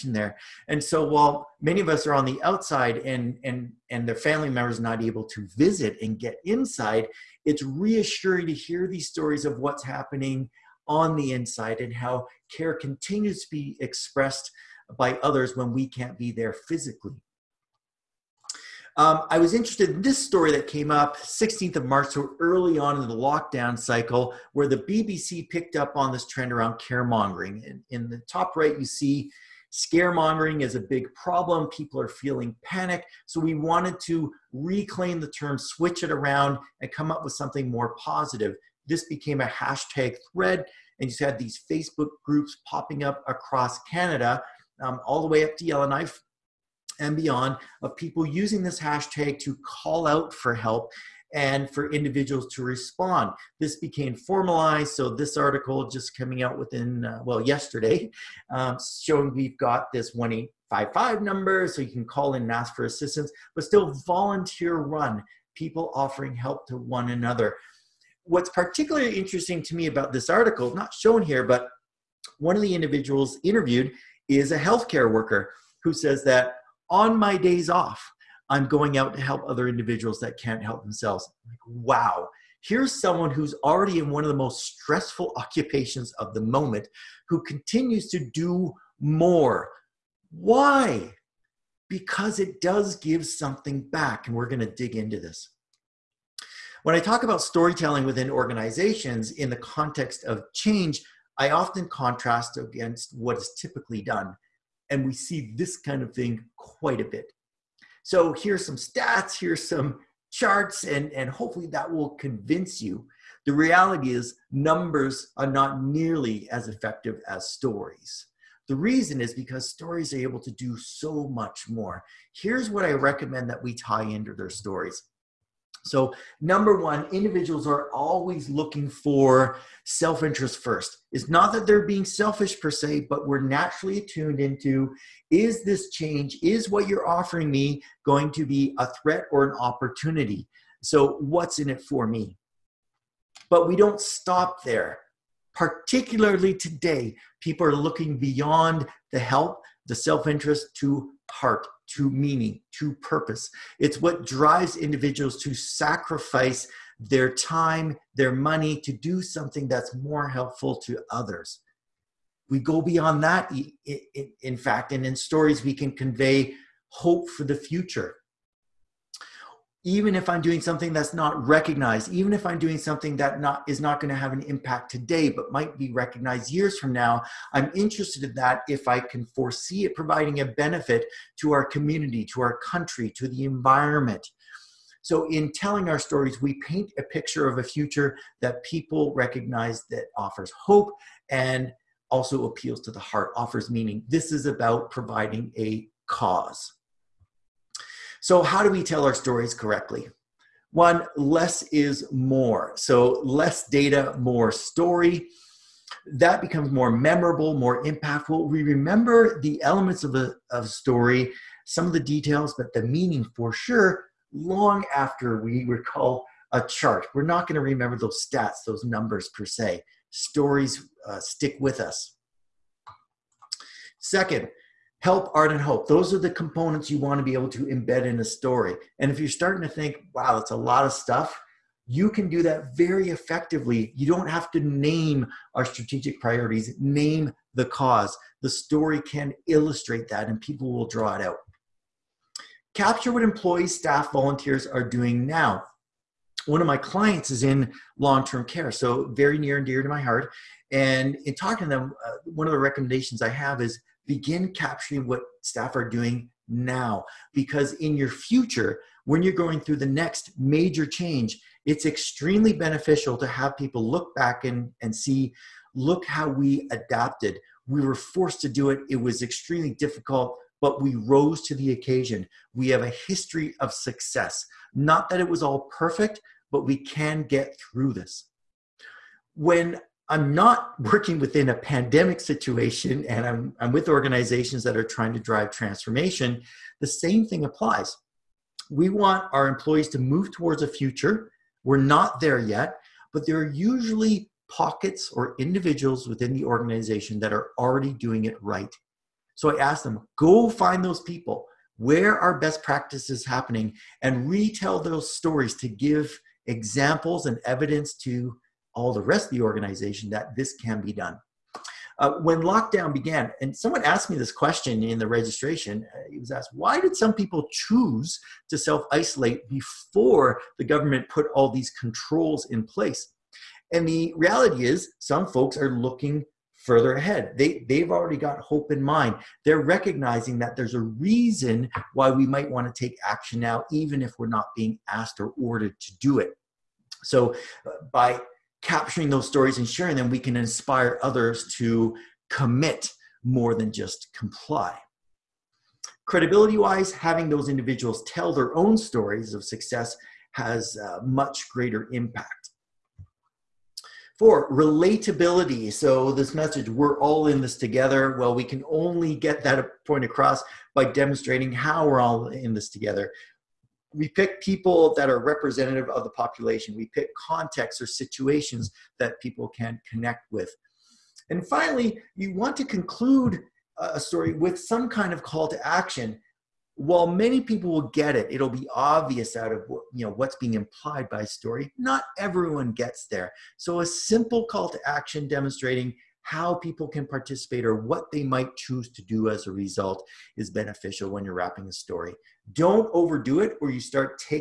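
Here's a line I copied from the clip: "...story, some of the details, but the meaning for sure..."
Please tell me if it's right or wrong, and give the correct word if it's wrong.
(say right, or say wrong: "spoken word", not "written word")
right.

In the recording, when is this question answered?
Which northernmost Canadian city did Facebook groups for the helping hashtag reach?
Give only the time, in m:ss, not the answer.
0:45.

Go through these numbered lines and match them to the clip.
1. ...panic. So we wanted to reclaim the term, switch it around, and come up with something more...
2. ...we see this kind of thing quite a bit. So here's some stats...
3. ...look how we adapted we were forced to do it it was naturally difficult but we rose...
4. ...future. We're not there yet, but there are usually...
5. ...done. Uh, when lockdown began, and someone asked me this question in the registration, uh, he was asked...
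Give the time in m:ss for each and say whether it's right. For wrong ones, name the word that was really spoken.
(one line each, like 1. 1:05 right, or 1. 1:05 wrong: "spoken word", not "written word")
1. 0:32 right
2. 1:45 right
3. 4:25 wrong: "extremely", not "naturally"
4. 4:50 right
5. 5:10 right.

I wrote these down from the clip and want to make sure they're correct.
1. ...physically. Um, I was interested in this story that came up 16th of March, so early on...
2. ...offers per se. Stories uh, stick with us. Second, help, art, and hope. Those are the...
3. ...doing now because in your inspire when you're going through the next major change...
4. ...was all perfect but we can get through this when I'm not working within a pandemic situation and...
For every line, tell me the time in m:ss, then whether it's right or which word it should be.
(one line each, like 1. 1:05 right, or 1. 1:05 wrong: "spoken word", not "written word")
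1. 0:16 right
2. 3:38 wrong: "numbers", not "offers"
3. 4:15 wrong: "future", not "inspire"
4. 4:35 right.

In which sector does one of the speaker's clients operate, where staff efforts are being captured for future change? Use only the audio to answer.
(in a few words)
long term care.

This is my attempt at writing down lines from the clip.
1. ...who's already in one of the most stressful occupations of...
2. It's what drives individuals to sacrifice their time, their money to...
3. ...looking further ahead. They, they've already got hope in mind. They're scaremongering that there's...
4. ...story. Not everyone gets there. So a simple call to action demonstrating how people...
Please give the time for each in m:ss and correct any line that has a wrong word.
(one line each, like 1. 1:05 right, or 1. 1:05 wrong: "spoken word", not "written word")
1. 1:23 right
2. 2:33 right
3. 5:25 wrong: "recognizing", not "scaremongering"
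4. 6:21 right.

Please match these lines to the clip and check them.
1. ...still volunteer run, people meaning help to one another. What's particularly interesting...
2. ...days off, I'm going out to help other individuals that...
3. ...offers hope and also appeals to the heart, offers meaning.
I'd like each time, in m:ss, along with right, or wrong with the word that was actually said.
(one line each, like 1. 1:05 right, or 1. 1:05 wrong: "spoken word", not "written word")
1. 1:03 wrong: "offering", not "meaning"
2. 1:17 right
3. 3:10 right.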